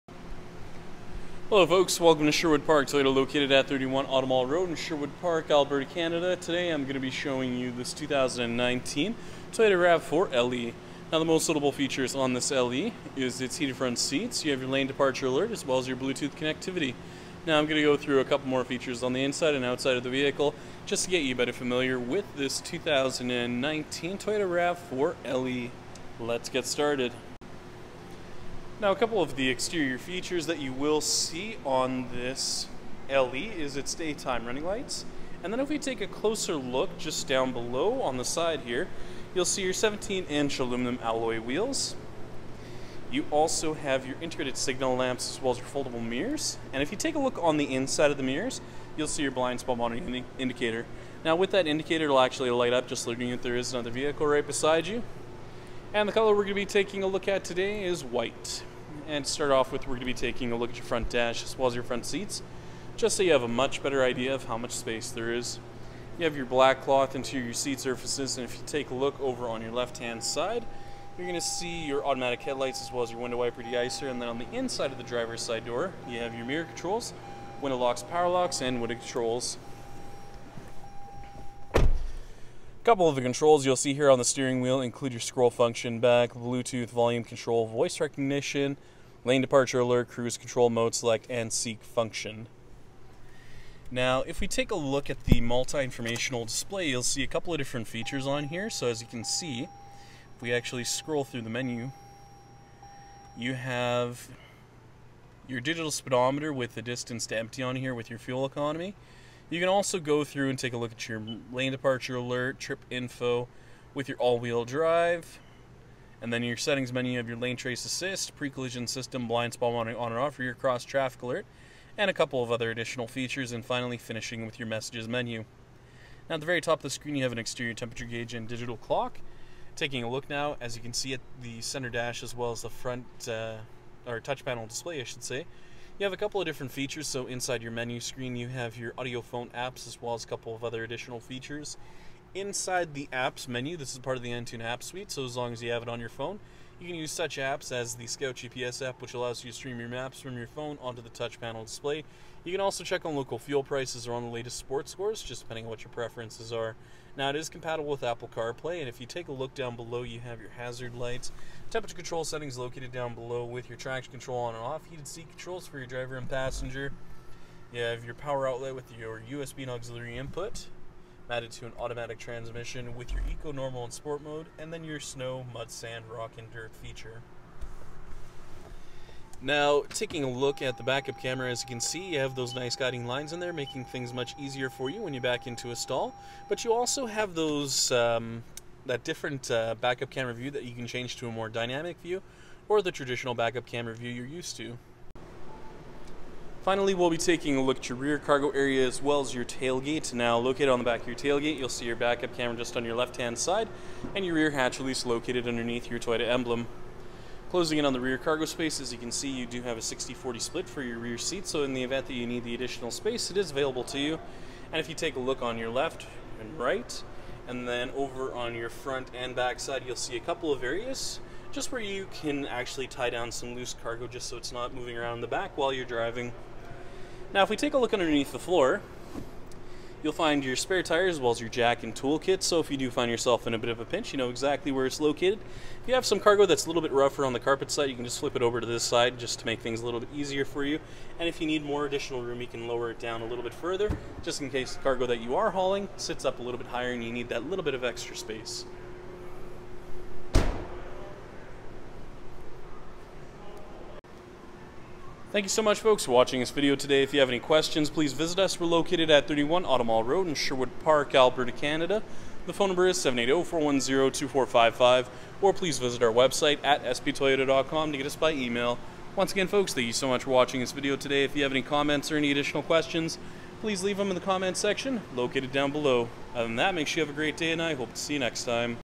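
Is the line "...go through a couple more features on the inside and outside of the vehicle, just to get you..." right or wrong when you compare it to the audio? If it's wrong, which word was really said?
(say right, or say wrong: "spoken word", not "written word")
right.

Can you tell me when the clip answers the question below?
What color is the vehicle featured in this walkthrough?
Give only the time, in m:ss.
0:58.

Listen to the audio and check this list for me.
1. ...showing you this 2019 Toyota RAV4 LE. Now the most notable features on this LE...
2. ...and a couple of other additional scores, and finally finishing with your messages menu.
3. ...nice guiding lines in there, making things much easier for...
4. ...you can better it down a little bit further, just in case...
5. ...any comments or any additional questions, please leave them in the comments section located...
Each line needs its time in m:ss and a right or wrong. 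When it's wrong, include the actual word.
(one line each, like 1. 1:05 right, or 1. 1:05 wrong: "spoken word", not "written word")
1. 0:07 right
2. 2:01 wrong: "features", not "scores"
3. 3:02 right
4. 4:02 wrong: "lower", not "better"
5. 4:31 right.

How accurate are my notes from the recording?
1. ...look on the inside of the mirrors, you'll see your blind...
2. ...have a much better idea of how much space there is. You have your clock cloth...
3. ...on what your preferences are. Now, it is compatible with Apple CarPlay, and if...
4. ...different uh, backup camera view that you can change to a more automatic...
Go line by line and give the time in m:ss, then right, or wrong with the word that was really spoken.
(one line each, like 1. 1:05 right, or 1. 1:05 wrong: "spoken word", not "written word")
1. 0:47 right
2. 1:03 wrong: "black", not "clock"
3. 2:35 right
4. 3:09 wrong: "dynamic", not "automatic".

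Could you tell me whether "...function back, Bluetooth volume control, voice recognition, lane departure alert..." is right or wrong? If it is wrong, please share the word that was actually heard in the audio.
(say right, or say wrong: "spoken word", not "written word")
right.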